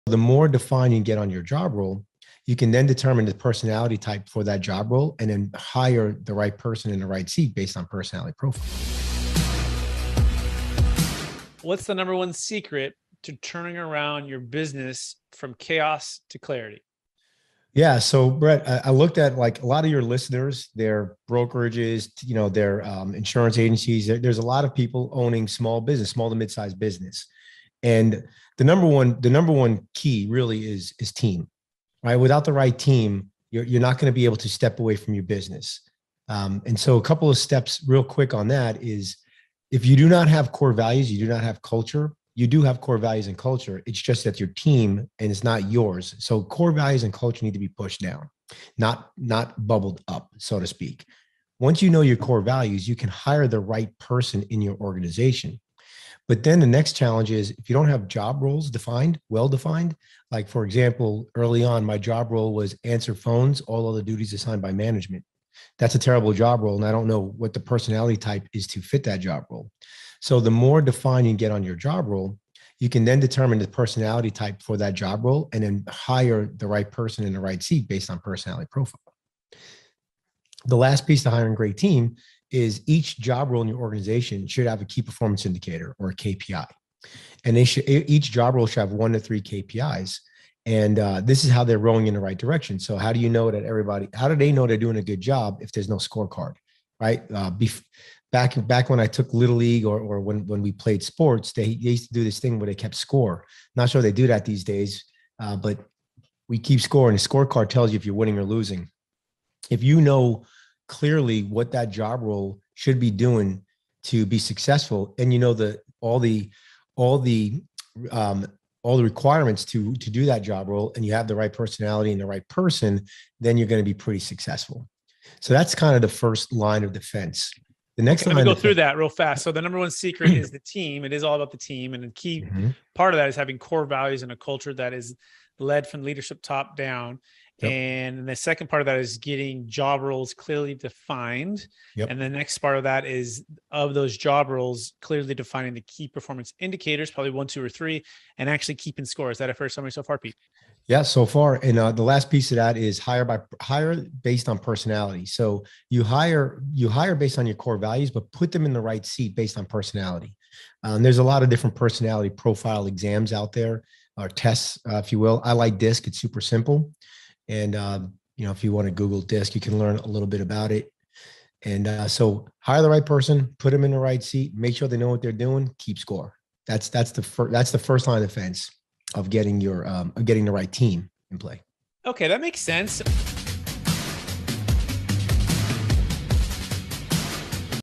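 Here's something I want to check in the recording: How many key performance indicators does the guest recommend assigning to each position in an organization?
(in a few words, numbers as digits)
1 to 3.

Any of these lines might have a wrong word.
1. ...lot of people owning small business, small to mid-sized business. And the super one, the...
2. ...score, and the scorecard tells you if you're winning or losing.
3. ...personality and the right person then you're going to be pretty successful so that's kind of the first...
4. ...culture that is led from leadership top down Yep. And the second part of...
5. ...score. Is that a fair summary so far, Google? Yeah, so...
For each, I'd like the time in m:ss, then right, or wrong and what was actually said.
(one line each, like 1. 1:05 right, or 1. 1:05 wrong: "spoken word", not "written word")
1. 0:24 wrong: "number", not "super"
2. 1:46 right
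3. 2:01 right
4. 2:14 right
5. 2:29 wrong: "Pete", not "Google".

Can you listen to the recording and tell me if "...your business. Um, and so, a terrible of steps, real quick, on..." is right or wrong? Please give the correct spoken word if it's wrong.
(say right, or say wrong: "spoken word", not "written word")
wrong: "couple", not "terrible".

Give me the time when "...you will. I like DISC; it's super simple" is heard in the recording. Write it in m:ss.
2:45.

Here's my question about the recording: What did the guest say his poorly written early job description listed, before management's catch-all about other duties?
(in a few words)
Answer phones.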